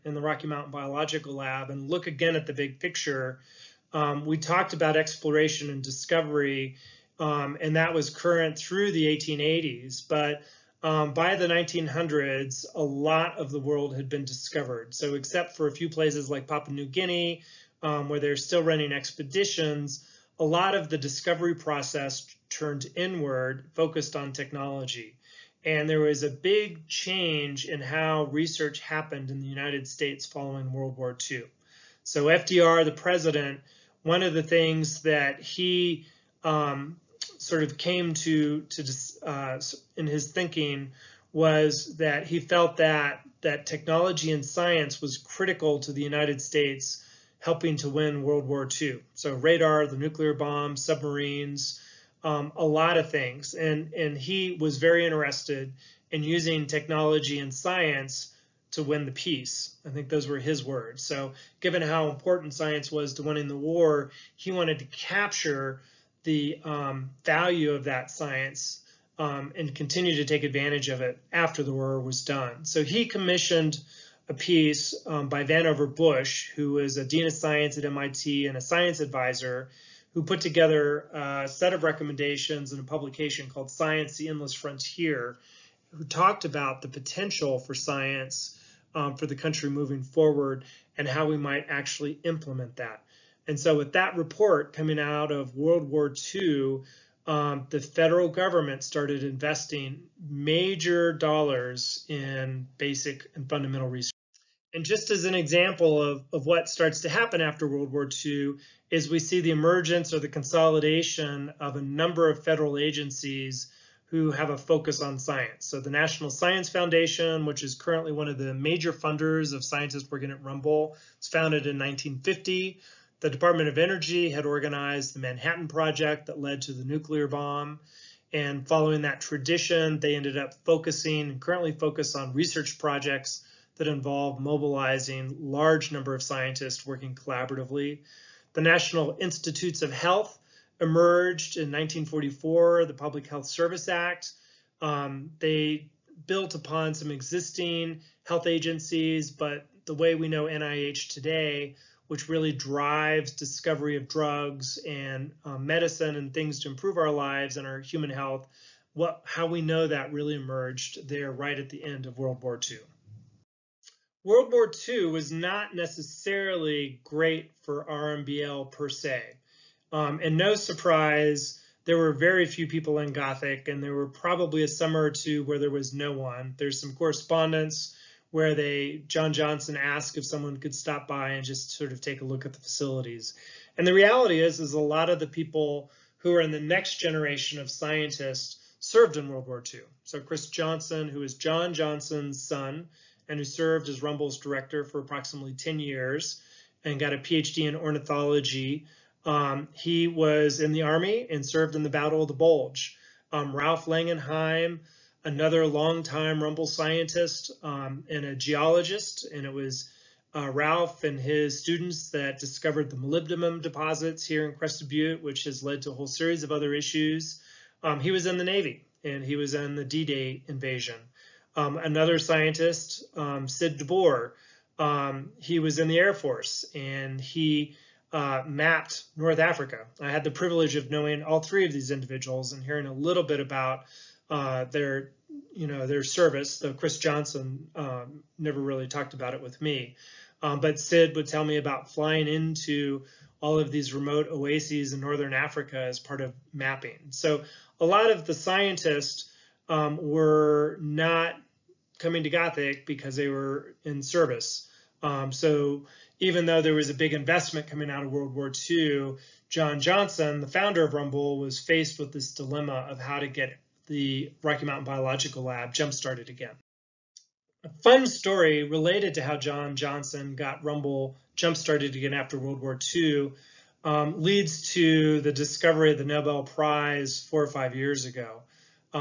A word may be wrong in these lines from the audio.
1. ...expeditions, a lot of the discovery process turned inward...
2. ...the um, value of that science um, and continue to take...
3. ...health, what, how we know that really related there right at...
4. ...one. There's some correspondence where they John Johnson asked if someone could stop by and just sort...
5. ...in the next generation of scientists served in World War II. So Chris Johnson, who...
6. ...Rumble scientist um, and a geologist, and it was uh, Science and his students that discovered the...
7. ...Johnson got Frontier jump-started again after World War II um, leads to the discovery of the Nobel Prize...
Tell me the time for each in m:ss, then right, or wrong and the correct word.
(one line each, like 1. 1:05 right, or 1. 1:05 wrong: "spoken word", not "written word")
1. 0:18 right
2. 1:06 right
3. 2:38 wrong: "emerged", not "related"
4. 2:56 right
5. 3:06 right
6. 3:26 wrong: "Ralph", not "Science"
7. 4:29 wrong: "Rumble", not "Frontier".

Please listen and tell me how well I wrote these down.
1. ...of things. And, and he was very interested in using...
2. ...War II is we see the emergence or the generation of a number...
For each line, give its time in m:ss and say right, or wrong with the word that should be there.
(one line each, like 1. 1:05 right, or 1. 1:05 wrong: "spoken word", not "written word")
1. 0:52 right
2. 1:47 wrong: "consolidation", not "generation".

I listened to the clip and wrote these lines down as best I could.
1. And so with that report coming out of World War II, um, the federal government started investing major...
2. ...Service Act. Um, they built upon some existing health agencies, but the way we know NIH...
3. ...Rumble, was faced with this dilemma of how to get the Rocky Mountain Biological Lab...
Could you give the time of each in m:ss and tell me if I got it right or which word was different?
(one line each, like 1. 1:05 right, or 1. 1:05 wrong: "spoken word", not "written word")
1. 1:33 right
2. 2:23 right
3. 4:20 right.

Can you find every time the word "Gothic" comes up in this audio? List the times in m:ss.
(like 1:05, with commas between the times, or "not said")
2:53, 4:12.